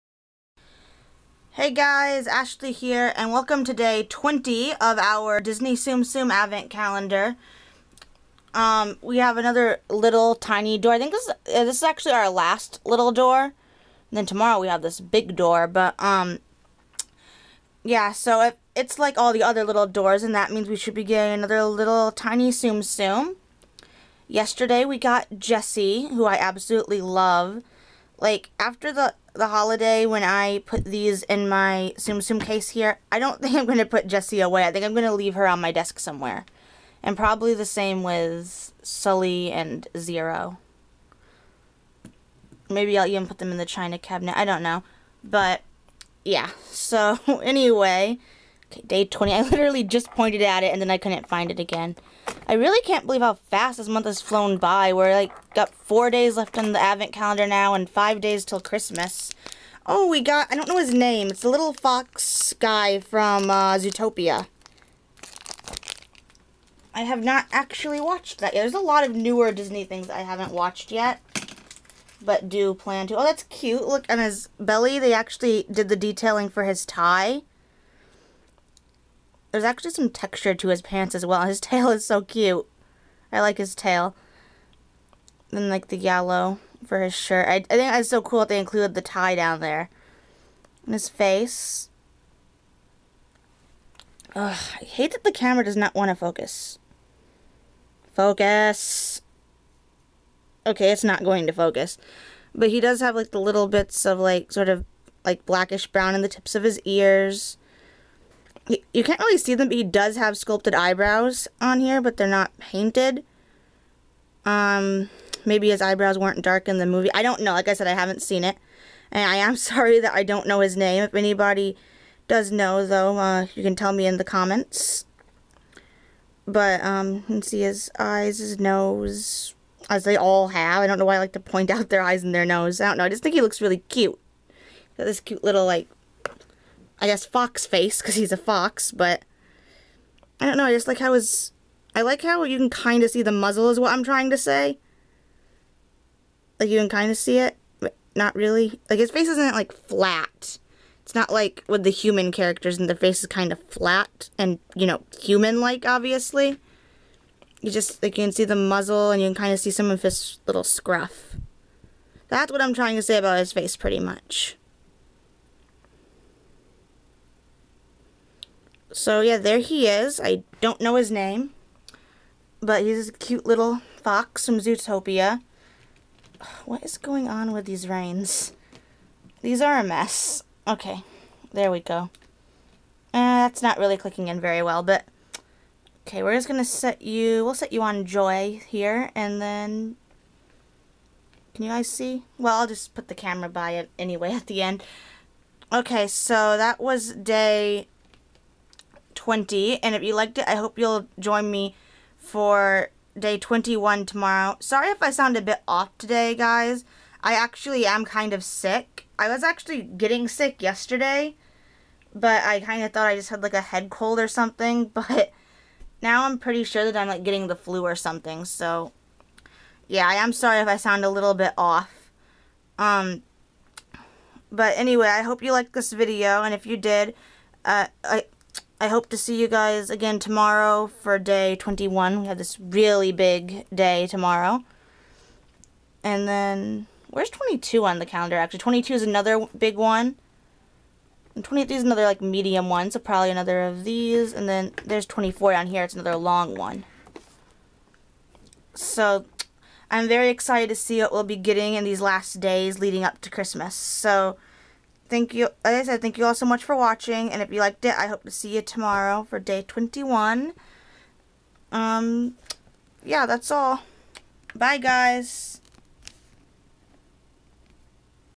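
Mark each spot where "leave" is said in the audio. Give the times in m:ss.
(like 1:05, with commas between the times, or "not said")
0:35.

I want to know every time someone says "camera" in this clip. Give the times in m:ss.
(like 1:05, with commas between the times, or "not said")
1:35, 3:13.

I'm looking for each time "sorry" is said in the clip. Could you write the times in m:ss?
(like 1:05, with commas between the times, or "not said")
1:59, 3:24, 3:40.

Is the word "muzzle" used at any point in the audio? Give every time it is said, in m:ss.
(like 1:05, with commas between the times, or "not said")
2:23, 2:38.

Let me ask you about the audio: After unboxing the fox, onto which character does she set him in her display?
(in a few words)
Joy.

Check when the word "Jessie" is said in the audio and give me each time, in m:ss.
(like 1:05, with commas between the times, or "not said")
0:25, 0:34.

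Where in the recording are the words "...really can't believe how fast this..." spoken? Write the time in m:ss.
0:52.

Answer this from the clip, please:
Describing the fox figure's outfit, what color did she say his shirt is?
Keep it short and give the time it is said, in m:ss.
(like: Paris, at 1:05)
Yellow, at 1:25.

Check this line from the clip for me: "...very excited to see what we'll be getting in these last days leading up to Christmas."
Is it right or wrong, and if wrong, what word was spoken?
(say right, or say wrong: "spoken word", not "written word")
right.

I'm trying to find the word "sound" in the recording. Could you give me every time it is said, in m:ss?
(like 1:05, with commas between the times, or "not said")
3:25, 3:40.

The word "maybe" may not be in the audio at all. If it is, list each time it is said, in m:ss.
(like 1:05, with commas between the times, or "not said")
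0:42, 1:55.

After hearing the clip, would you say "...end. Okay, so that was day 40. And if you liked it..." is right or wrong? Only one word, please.
wrong.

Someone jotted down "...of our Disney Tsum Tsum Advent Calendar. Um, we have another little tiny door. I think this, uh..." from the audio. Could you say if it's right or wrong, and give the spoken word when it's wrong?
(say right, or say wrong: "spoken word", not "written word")
right.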